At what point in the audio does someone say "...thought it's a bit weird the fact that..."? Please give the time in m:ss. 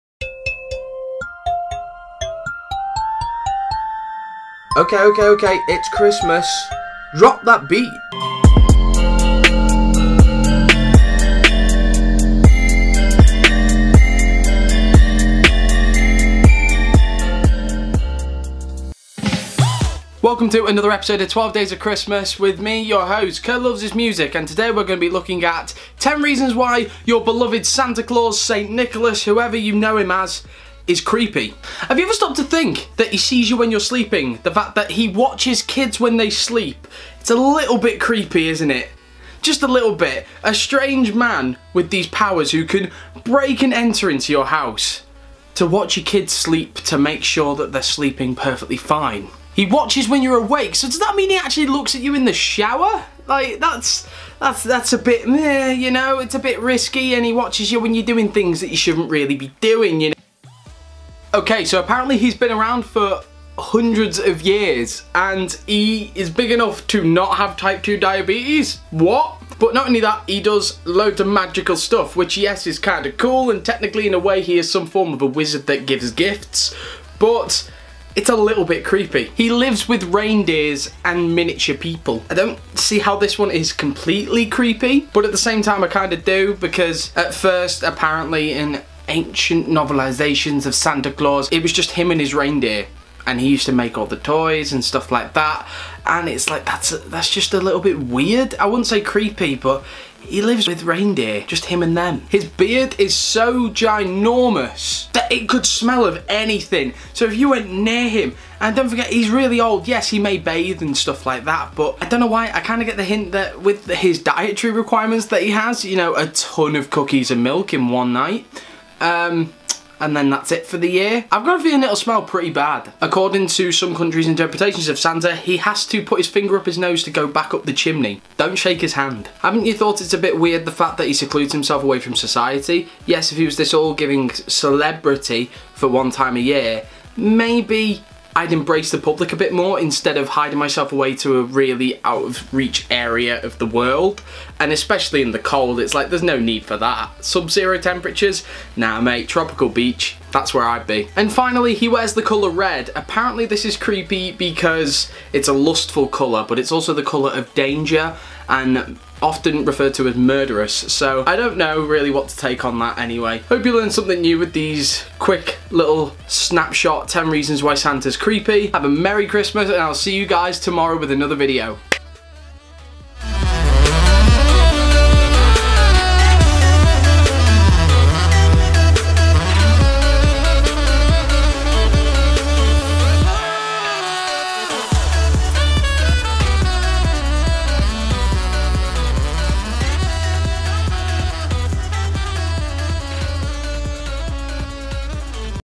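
2:09.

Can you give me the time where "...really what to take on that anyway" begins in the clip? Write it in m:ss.
2:41.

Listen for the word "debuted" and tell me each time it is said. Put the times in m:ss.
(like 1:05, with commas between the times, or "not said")
not said.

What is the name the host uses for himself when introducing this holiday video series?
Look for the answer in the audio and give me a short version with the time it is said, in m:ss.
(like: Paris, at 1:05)
Curly Loves His Music, at 0:23.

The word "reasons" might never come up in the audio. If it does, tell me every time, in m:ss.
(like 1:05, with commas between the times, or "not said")
0:26, 2:47.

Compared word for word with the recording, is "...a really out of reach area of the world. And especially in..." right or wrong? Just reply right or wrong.
right.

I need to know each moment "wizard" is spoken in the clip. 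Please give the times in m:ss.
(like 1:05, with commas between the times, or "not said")
1:15.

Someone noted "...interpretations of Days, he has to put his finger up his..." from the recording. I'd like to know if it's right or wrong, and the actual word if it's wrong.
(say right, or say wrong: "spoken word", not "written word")
wrong: "Santa", not "Days".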